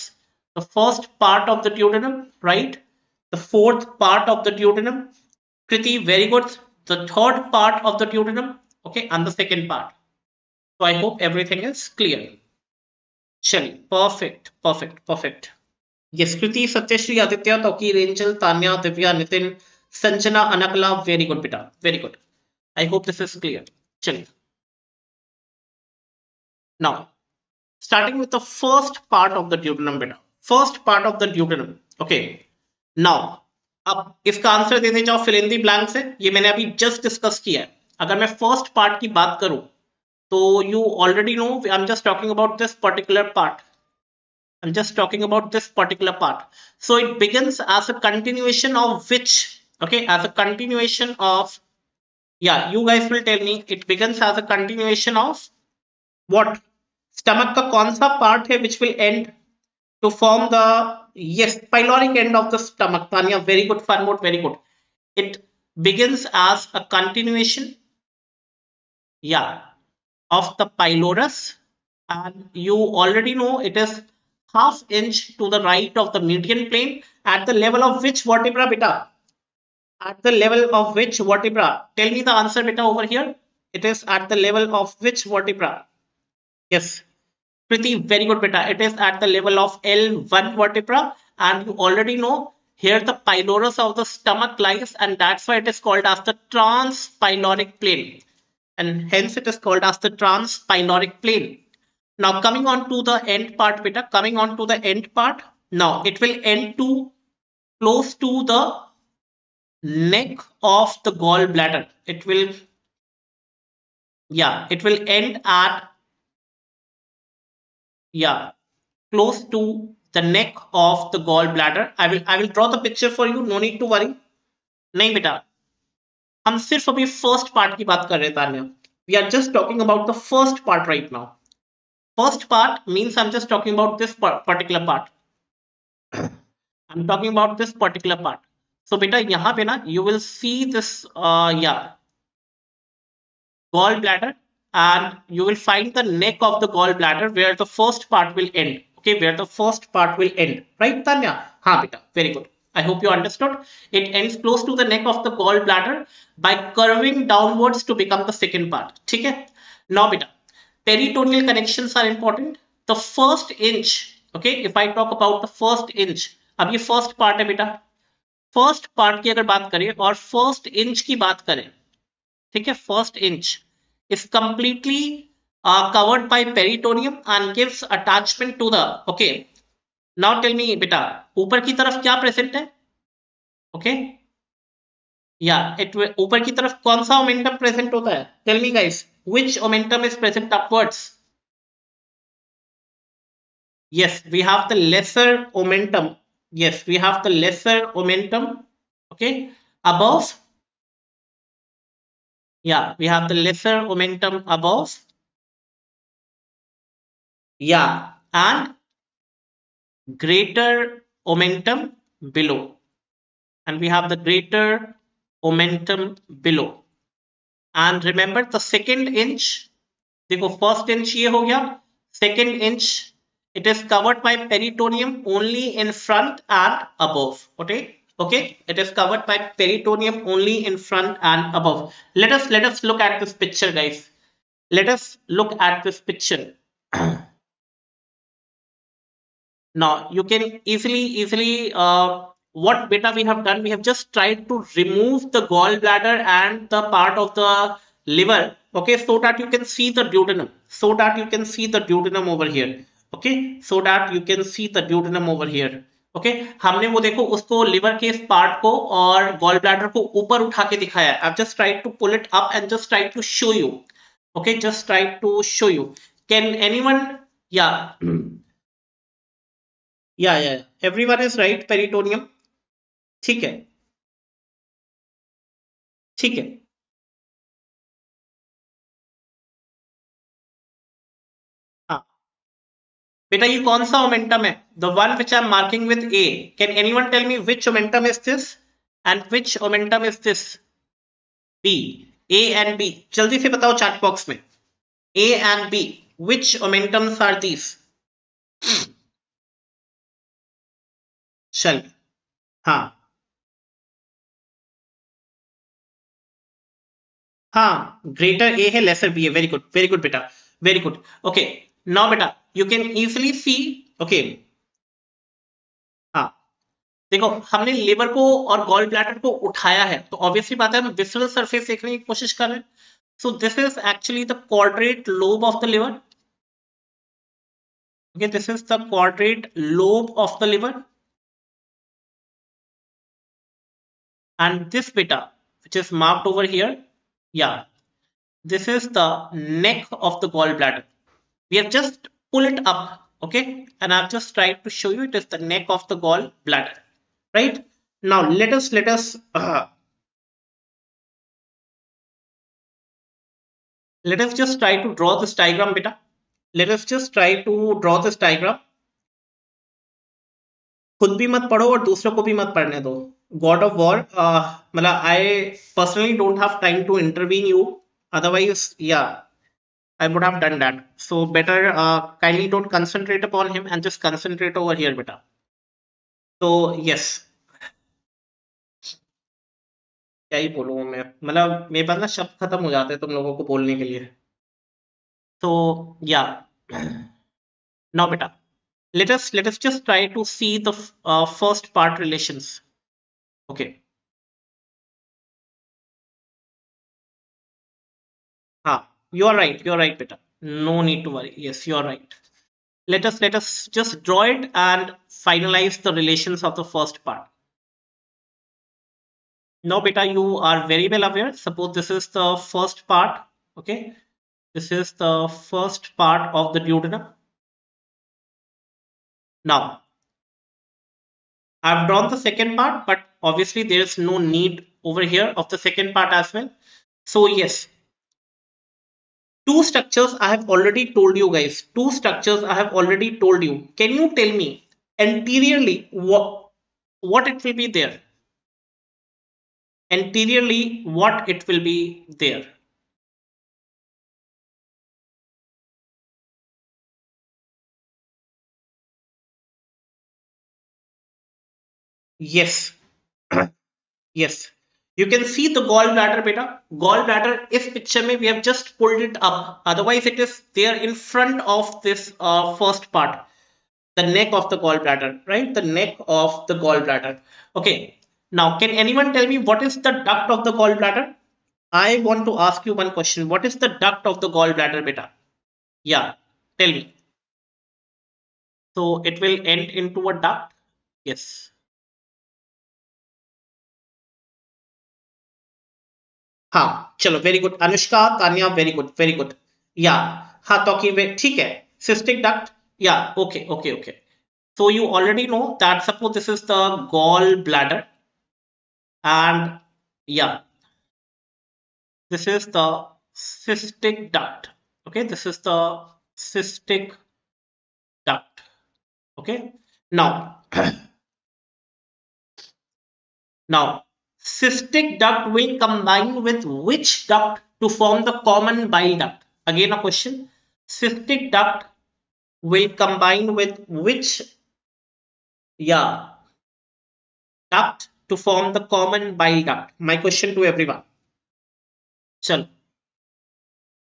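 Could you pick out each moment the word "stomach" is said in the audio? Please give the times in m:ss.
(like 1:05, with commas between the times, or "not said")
0:57, 1:02, 1:34.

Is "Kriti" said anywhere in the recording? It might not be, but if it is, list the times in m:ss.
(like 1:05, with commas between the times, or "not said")
0:05.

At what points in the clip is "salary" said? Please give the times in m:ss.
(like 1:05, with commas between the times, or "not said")
not said.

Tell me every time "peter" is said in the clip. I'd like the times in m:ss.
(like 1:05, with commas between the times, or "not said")
1:43, 6:39.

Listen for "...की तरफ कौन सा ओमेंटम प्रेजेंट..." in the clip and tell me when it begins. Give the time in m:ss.
3:06.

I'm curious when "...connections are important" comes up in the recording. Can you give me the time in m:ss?
2:41.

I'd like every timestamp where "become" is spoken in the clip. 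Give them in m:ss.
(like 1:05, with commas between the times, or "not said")
2:37.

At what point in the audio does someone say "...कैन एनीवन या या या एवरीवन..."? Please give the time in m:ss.
4:26.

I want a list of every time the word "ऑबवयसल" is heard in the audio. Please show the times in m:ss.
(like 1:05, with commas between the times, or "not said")
5:20.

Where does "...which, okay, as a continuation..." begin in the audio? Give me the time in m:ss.
0:49.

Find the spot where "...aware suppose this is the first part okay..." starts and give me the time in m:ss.
6:51.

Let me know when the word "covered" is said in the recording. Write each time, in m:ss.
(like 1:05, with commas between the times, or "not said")
2:55, 3:43, 3:48.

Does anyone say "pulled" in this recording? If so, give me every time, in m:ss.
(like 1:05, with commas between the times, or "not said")
5:42, 7:38.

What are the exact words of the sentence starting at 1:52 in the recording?
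It will, yeah, it will end at, yeah, close to the neck of the gallbladder.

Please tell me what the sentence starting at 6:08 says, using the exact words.
Otherwise, yeah, I would have done that.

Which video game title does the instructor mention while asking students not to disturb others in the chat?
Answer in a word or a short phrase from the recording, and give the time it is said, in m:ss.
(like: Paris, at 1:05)
God of War, at 6:03.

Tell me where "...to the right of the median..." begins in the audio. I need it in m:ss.
1:15.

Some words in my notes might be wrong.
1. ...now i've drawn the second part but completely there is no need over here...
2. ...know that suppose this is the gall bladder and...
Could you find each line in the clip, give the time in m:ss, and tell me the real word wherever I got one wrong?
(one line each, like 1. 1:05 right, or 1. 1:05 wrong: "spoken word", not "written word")
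1. 6:59 wrong: "obviously", not "completely"
2. 8:15 right.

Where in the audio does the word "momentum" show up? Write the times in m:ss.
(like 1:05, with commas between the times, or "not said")
3:31, 3:35.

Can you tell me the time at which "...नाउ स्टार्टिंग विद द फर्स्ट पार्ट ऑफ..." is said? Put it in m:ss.
0:26.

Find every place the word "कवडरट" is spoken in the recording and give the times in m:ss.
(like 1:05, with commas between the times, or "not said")
5:24.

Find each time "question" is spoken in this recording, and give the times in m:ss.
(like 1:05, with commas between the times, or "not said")
7:52, 8:39, 8:49.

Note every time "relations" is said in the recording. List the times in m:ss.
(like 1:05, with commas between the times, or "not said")
6:46.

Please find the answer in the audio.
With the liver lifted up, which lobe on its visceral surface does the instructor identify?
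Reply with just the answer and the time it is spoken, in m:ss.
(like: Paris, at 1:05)
quadrate lobe, at 5:28.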